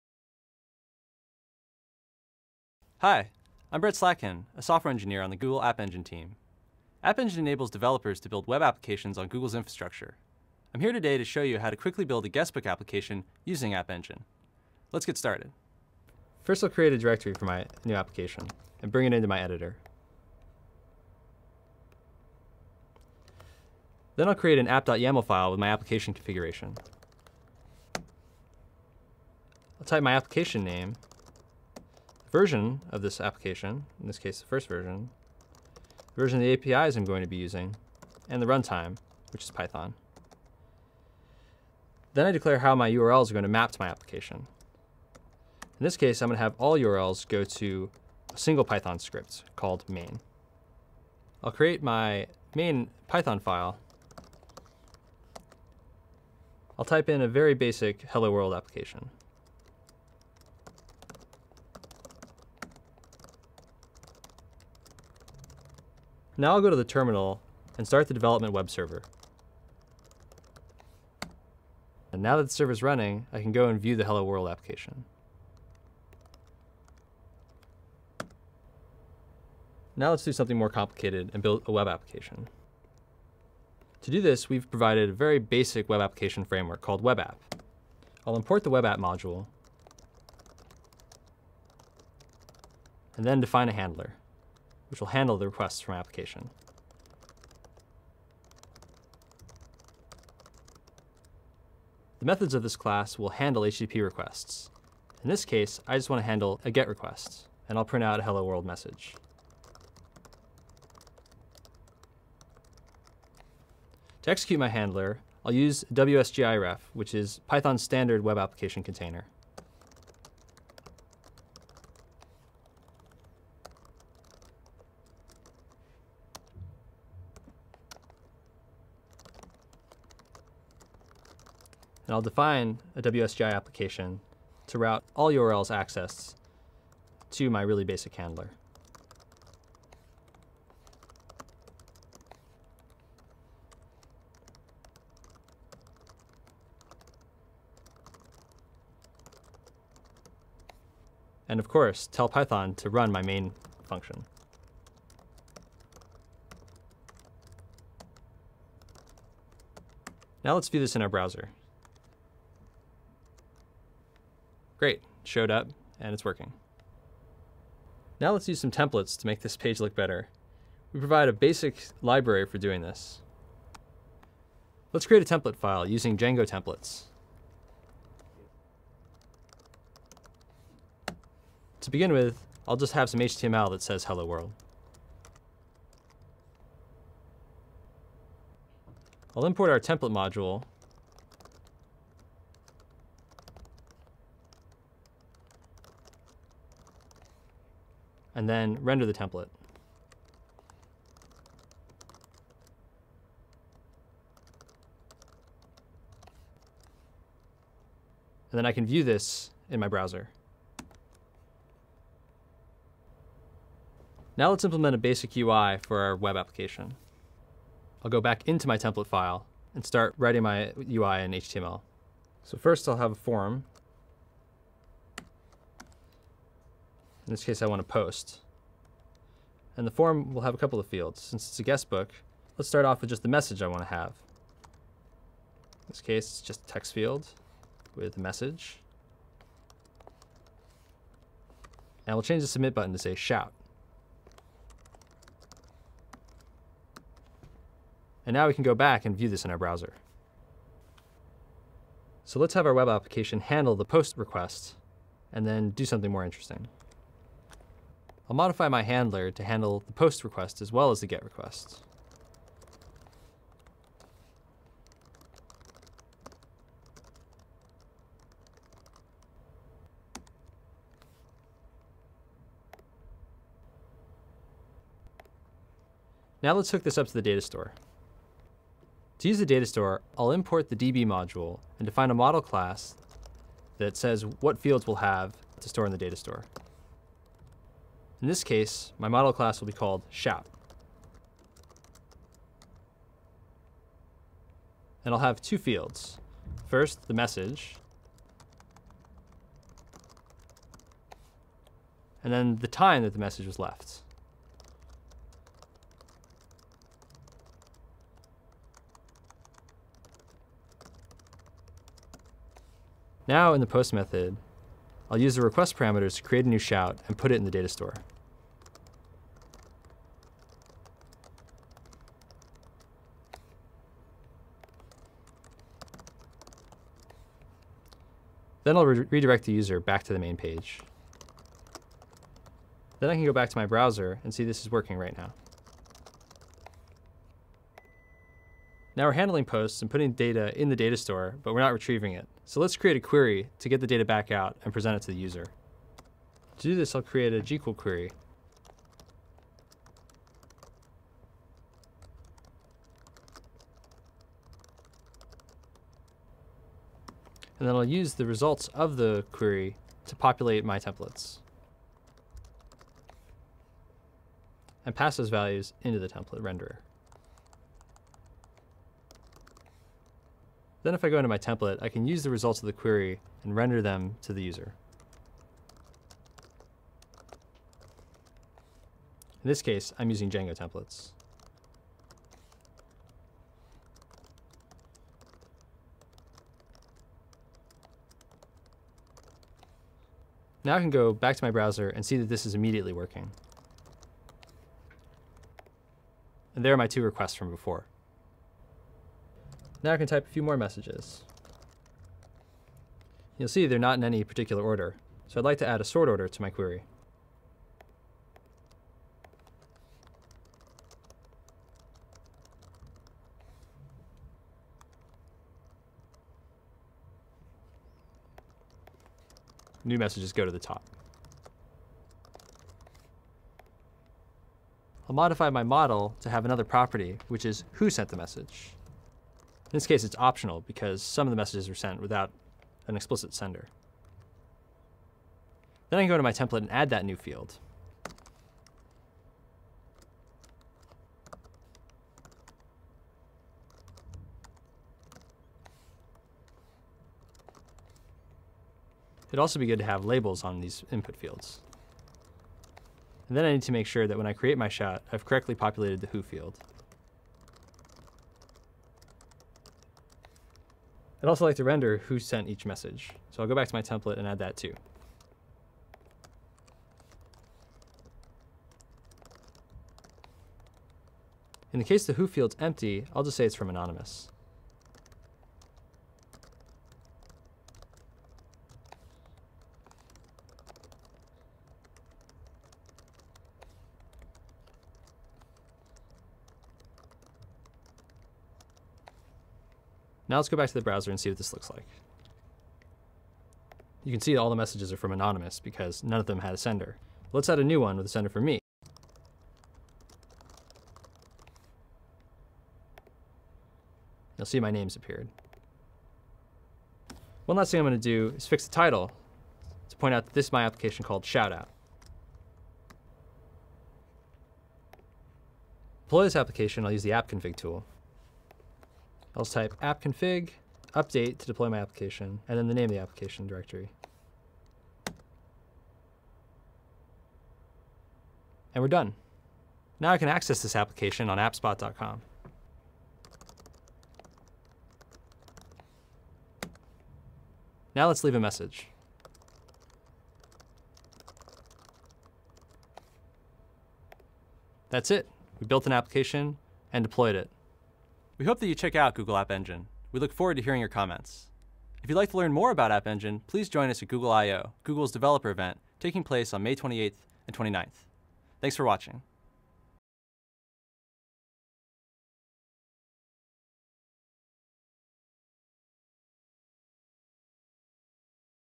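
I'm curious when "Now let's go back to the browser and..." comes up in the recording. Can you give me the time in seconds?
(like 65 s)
490 s.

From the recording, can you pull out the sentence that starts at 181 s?
To begin with, I'll just have some HTML that says hello world.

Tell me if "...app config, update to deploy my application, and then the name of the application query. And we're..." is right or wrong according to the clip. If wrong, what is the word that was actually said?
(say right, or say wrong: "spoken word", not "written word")
wrong: "directory", not "query".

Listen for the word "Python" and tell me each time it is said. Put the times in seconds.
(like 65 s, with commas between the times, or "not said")
39 s, 48 s, 53 s, 117 s, 152 s.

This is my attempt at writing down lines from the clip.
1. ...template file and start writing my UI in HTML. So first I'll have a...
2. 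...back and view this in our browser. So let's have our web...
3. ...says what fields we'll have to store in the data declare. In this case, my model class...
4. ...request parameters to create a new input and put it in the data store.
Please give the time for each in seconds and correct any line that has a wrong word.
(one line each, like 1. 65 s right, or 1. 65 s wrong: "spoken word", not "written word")
1. 218 s right
2. 248 s right
3. 283 s wrong: "store", not "declare"
4. 315 s wrong: "shout", not "input".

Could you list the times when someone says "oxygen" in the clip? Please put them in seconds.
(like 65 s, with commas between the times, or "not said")
not said.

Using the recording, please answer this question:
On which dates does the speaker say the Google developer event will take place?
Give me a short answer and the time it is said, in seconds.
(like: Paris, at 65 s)
May 28th and 29th, at 556 s.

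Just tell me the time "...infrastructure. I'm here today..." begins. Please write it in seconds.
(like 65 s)
9 s.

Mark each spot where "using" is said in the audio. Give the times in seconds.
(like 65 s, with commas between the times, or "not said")
13 s, 37 s, 175 s, 380 s.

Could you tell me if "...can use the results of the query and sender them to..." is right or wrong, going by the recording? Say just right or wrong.
wrong.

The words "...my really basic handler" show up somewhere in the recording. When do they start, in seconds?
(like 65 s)
137 s.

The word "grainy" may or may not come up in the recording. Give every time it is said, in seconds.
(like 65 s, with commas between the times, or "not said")
not said.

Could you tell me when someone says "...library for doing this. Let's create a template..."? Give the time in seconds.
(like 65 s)
172 s.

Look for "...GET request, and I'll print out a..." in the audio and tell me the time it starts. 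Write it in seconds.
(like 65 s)
106 s.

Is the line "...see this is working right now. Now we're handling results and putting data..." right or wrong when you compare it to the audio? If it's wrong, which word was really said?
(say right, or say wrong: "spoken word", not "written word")
wrong: "posts", not "results".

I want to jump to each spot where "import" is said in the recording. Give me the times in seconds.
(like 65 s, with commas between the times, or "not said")
88 s, 189 s, 280 s.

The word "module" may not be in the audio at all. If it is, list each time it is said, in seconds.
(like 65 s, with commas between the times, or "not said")
88 s, 190 s, 281 s.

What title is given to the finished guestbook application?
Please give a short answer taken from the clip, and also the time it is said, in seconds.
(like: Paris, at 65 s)
Shoutout, at 511 s.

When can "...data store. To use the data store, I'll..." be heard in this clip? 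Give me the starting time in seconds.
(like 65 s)
277 s.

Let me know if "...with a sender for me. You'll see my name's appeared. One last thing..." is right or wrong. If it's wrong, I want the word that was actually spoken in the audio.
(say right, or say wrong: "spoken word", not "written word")
right.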